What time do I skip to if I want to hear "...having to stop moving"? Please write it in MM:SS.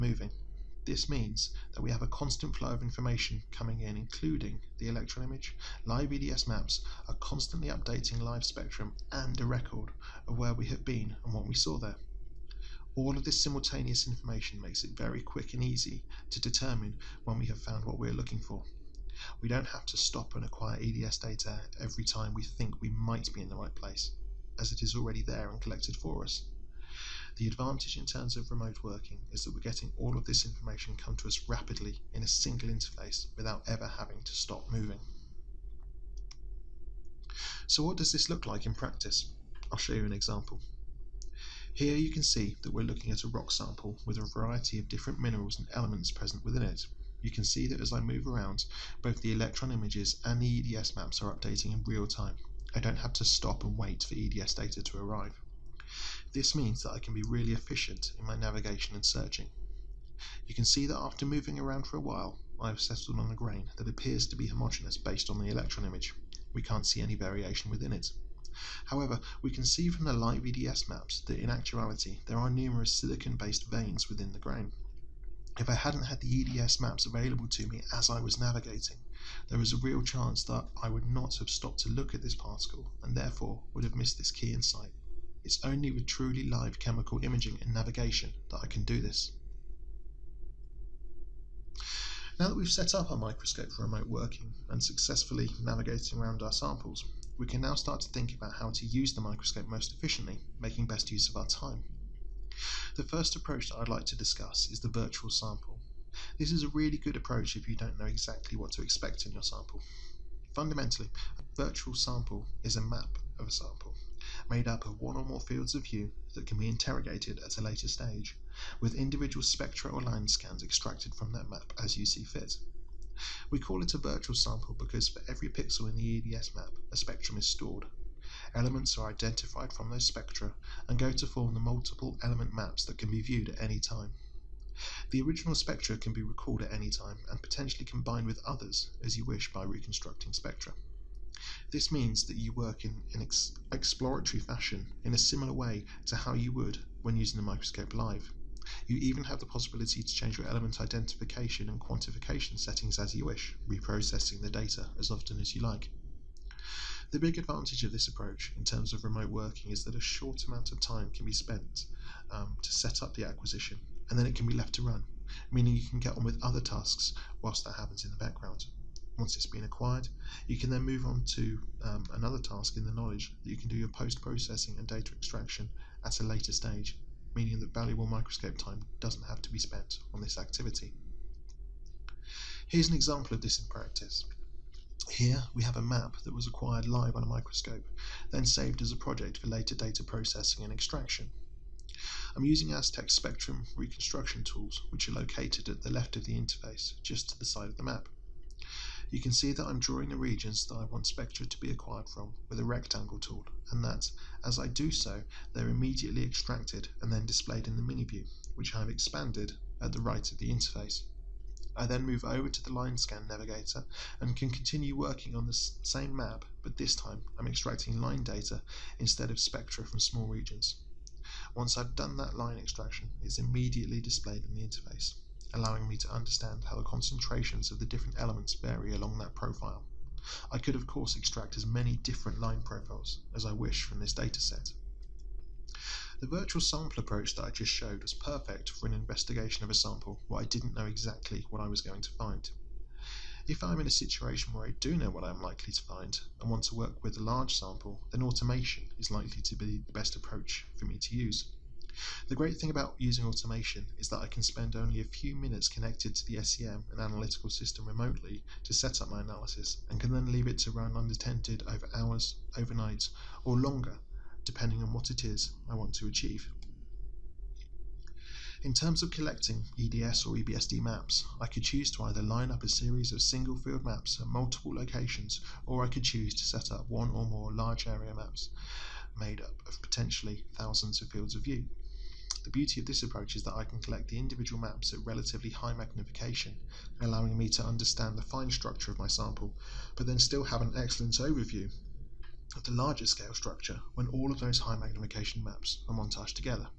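00:33.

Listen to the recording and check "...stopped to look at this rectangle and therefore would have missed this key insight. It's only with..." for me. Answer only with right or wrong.
wrong.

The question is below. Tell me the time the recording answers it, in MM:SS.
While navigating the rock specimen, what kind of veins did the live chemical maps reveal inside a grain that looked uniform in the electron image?
01:12.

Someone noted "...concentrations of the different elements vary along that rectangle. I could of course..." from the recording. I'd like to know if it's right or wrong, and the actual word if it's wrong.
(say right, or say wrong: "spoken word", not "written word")
wrong: "profile", not "rectangle".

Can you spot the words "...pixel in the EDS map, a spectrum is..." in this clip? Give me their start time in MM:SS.
02:05.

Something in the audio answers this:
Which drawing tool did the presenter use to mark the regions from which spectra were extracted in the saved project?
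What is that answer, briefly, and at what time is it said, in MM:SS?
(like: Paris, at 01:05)
rectangle tool, at 03:22.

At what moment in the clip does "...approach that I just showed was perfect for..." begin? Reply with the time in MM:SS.
03:56.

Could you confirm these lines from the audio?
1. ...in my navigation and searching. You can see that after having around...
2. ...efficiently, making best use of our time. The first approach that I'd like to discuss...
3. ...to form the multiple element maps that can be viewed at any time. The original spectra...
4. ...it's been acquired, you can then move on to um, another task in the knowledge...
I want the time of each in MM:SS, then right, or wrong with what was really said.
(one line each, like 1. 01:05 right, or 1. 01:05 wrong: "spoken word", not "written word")
1. 00:58 wrong: "moving", not "having"
2. 01:39 right
3. 02:11 right
4. 02:49 right.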